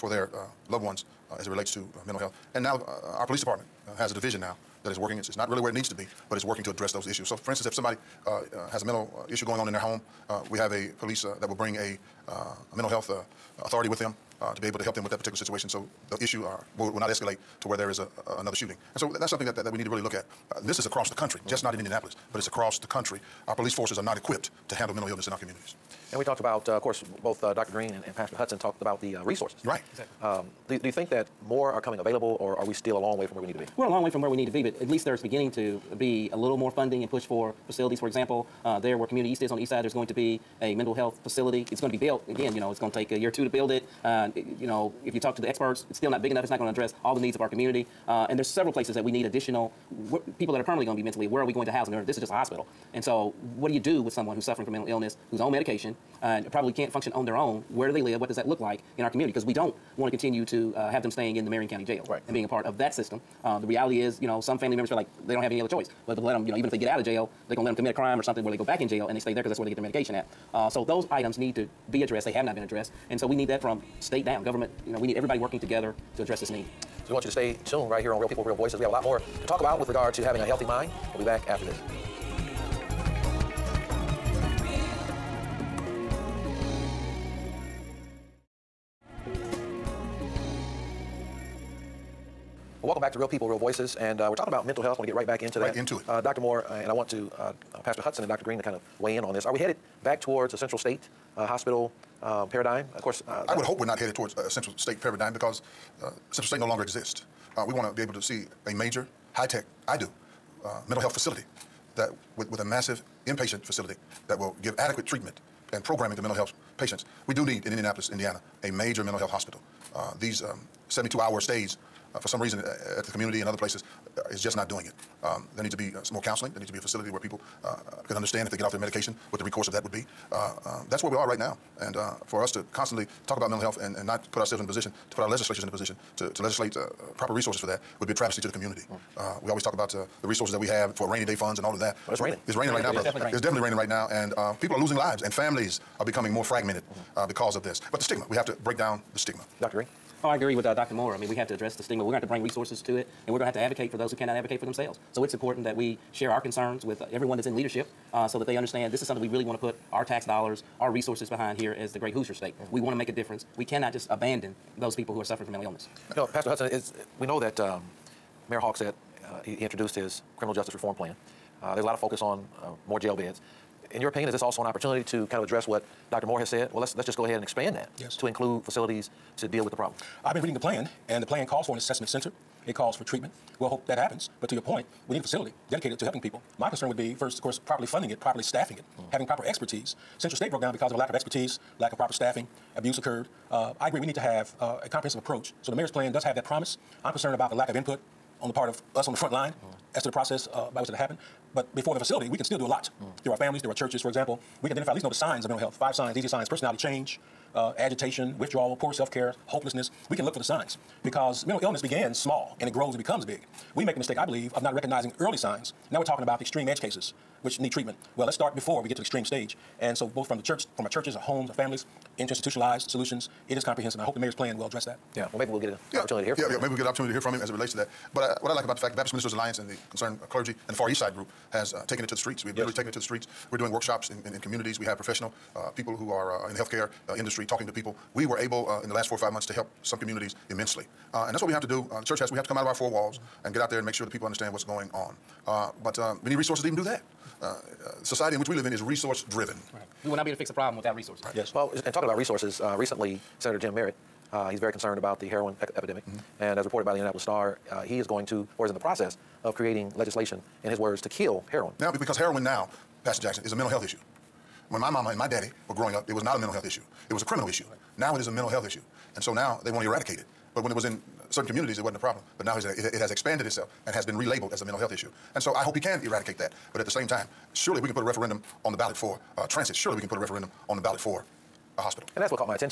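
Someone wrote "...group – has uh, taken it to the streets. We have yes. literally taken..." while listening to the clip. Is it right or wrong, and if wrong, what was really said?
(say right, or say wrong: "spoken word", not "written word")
right.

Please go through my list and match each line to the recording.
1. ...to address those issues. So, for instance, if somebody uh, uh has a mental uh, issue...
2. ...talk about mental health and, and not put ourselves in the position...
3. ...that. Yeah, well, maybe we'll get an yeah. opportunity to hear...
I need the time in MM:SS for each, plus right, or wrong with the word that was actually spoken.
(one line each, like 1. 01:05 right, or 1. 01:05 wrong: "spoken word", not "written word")
1. 00:06 right
2. 02:13 right
3. 03:44 right.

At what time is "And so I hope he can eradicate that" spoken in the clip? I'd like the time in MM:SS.
04:35.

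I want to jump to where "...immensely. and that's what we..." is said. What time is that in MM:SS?
04:00.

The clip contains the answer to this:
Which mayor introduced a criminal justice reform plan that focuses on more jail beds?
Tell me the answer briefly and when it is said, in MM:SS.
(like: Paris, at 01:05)
Mayor Hogsett, at 02:48.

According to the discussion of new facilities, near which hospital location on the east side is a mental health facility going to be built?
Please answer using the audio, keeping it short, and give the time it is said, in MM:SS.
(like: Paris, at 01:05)
Community East, at 00:39.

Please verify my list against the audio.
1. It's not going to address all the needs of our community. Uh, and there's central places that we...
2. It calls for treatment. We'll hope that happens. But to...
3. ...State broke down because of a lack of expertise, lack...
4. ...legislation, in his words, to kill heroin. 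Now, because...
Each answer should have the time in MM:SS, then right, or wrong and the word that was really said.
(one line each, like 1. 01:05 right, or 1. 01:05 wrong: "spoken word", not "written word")
1. 00:46 wrong: "several", not "central"
2. 03:02 right
3. 03:10 right
4. 04:19 right.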